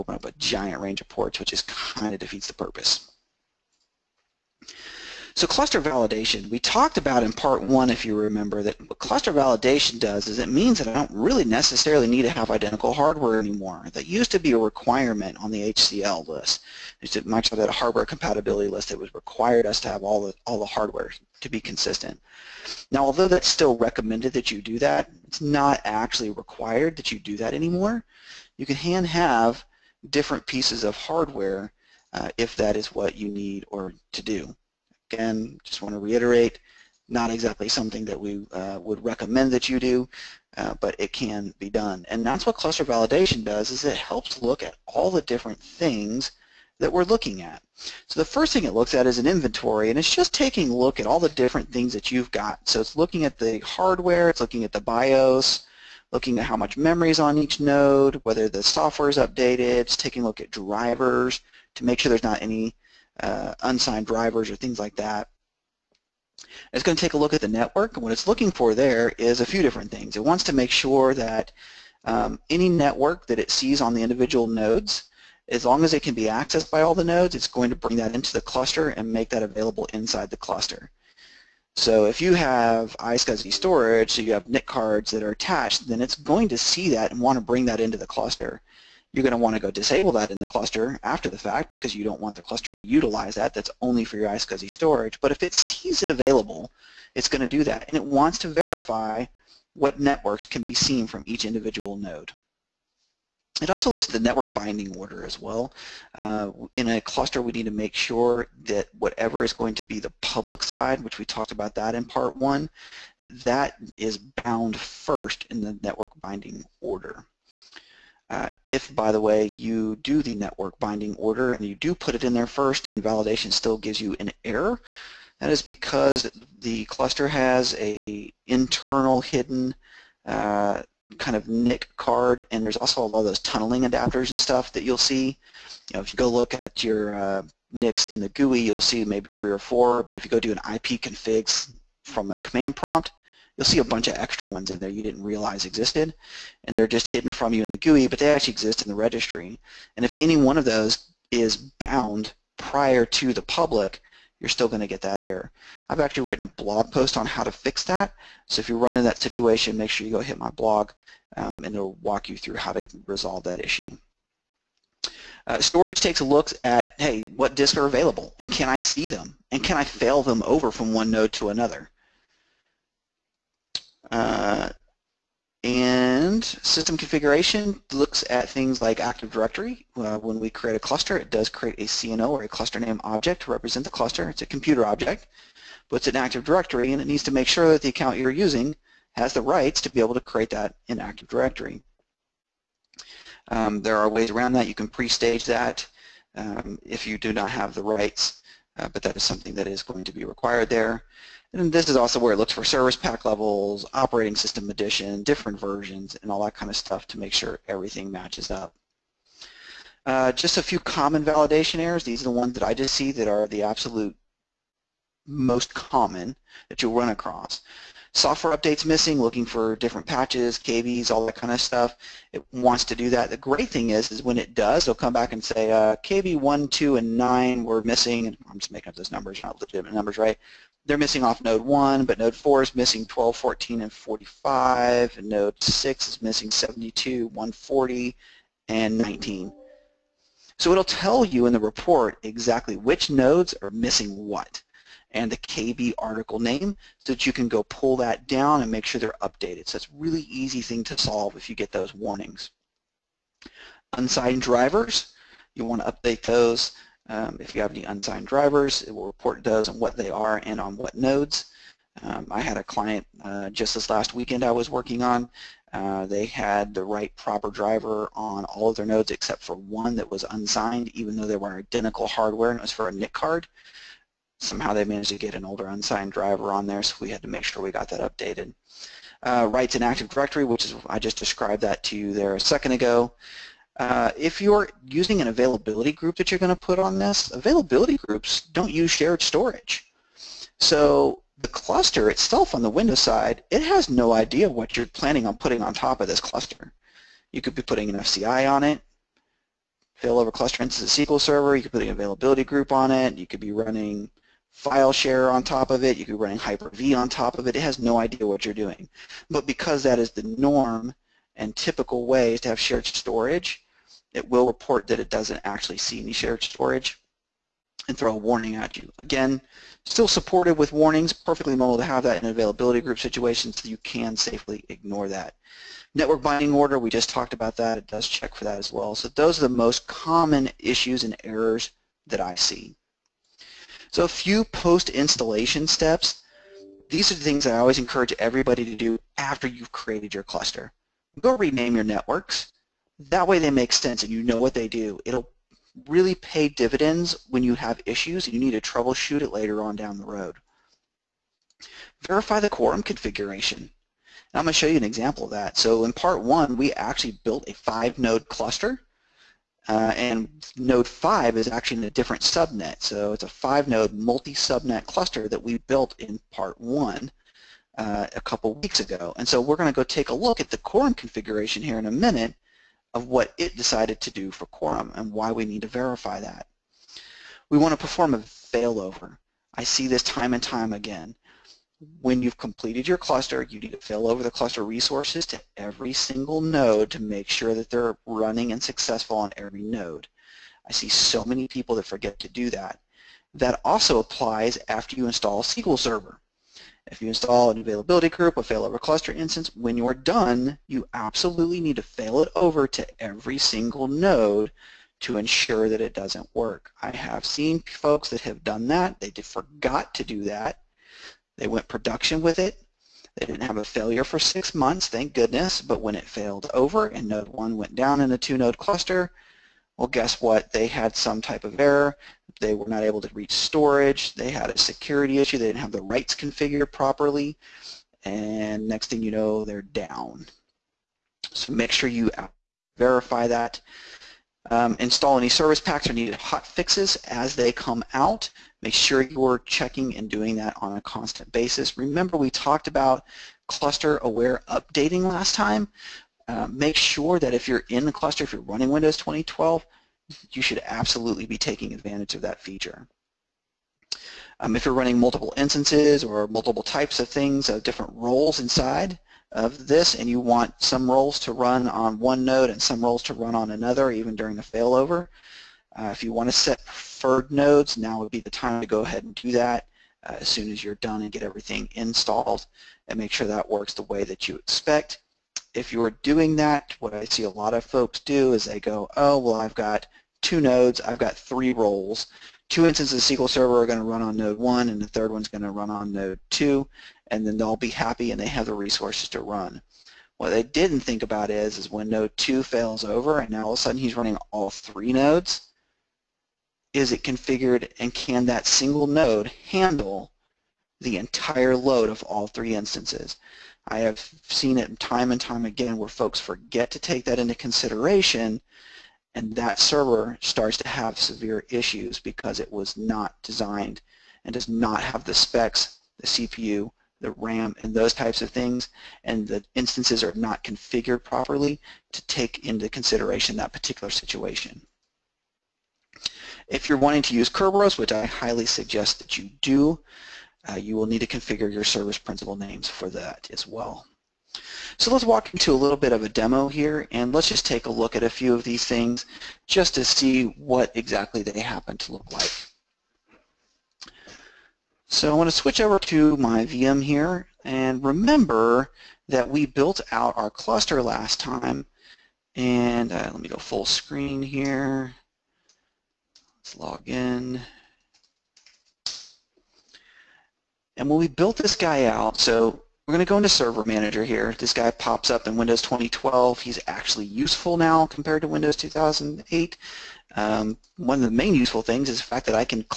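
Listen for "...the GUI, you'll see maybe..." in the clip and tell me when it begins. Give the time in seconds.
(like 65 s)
138 s.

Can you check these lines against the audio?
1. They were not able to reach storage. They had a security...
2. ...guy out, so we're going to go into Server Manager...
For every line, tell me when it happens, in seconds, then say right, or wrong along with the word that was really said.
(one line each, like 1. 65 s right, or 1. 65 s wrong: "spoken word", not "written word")
1. 422 s right
2. 561 s right.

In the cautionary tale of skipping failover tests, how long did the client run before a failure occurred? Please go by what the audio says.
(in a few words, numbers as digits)
6 months.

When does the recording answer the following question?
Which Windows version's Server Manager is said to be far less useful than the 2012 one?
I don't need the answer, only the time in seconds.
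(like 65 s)
568 s.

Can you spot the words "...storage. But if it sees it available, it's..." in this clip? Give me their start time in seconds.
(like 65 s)
94 s.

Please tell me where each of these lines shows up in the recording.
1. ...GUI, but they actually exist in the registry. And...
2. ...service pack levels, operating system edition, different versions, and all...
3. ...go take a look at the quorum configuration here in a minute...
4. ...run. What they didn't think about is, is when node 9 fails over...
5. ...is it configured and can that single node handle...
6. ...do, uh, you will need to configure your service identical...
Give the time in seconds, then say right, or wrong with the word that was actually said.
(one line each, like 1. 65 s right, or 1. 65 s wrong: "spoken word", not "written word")
1. 147 s right
2. 202 s right
3. 369 s right
4. 489 s wrong: "2", not "9"
5. 496 s right
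6. 529 s wrong: "principal", not "identical".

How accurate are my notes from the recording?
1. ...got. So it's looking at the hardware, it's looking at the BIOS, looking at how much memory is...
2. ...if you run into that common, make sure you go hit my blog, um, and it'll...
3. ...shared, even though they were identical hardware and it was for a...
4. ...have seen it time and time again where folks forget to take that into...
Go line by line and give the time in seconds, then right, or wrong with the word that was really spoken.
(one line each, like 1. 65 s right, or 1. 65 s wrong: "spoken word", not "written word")
1. 52 s right
2. 158 s wrong: "situation", not "common"
3. 270 s wrong: "unsigned", not "shared"
4. 503 s right.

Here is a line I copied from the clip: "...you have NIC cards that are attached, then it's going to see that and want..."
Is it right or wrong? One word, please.
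right.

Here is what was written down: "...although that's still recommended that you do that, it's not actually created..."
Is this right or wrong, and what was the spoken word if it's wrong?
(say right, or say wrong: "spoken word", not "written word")
wrong: "required", not "created".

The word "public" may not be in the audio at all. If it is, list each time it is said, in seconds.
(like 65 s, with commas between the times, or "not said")
110 s, 153 s.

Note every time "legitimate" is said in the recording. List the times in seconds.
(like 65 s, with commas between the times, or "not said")
229 s.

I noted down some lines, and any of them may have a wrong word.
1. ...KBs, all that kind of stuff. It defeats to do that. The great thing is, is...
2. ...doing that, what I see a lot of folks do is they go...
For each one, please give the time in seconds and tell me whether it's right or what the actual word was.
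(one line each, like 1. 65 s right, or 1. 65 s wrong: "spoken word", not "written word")
1. 220 s wrong: "wants", not "defeats"
2. 476 s right.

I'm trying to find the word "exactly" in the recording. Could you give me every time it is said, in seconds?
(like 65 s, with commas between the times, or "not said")
37 s, 242 s, 540 s.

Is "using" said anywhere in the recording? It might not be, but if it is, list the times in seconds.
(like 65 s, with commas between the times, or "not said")
188 s, 284 s.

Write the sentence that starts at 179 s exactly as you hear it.
Uh, when we create a cluster, it does create a CNO or a cluster name object to represent the cluster.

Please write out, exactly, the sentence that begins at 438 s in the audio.
Make sure you're checking and doing that on a constant basis.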